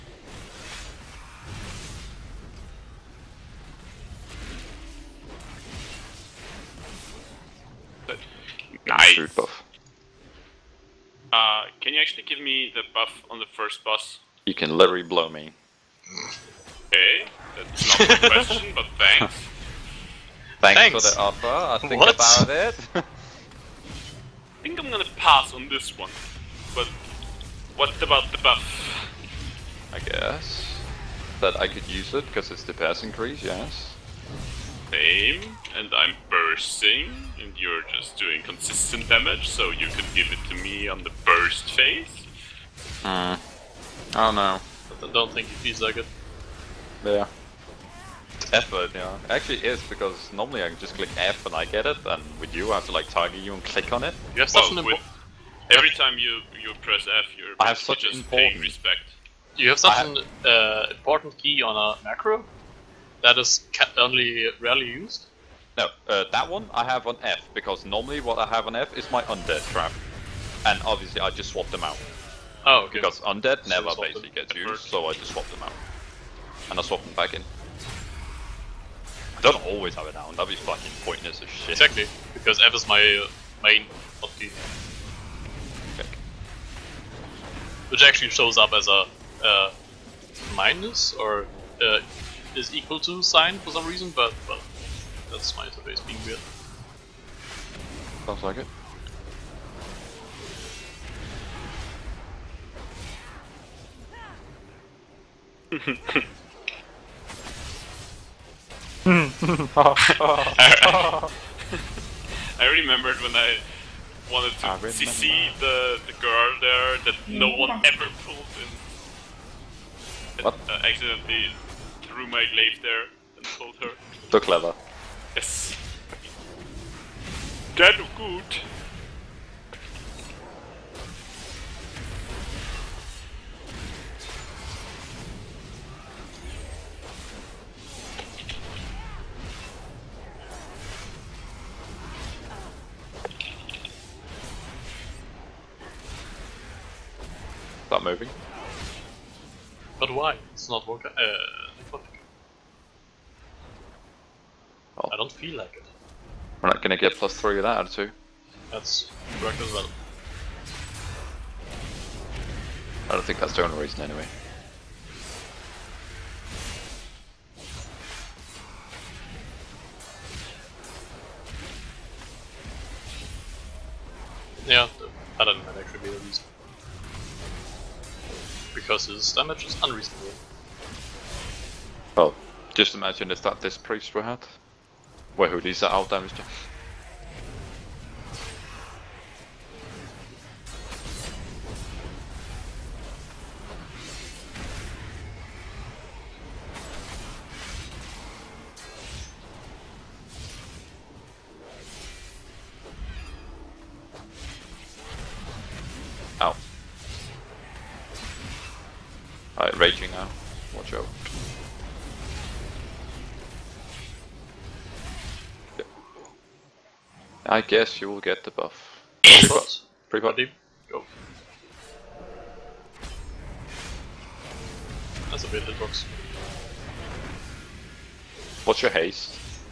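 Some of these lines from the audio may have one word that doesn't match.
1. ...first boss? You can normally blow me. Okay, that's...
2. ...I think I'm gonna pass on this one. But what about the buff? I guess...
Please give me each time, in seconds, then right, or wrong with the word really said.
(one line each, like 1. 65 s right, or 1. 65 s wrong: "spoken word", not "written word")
1. 13 s wrong: "literally", not "normally"
2. 22 s right.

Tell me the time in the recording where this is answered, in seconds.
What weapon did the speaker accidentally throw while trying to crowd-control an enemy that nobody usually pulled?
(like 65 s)
122 s.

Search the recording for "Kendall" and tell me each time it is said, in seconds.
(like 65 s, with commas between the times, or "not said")
not said.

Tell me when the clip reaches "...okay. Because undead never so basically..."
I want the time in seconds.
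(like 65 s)
72 s.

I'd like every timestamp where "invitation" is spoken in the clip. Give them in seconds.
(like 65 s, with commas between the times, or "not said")
not said.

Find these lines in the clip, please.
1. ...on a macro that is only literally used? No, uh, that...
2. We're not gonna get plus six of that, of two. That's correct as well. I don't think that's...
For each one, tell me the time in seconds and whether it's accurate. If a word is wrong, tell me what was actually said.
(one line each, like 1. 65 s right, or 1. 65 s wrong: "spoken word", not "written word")
1. 61 s wrong: "rarely", not "literally"
2. 156 s wrong: "three", not "six".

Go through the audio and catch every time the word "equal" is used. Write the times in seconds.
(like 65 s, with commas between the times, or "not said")
92 s.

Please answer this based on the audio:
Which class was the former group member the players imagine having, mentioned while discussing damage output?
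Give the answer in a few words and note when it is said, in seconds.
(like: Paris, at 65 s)
Priest, at 183 s.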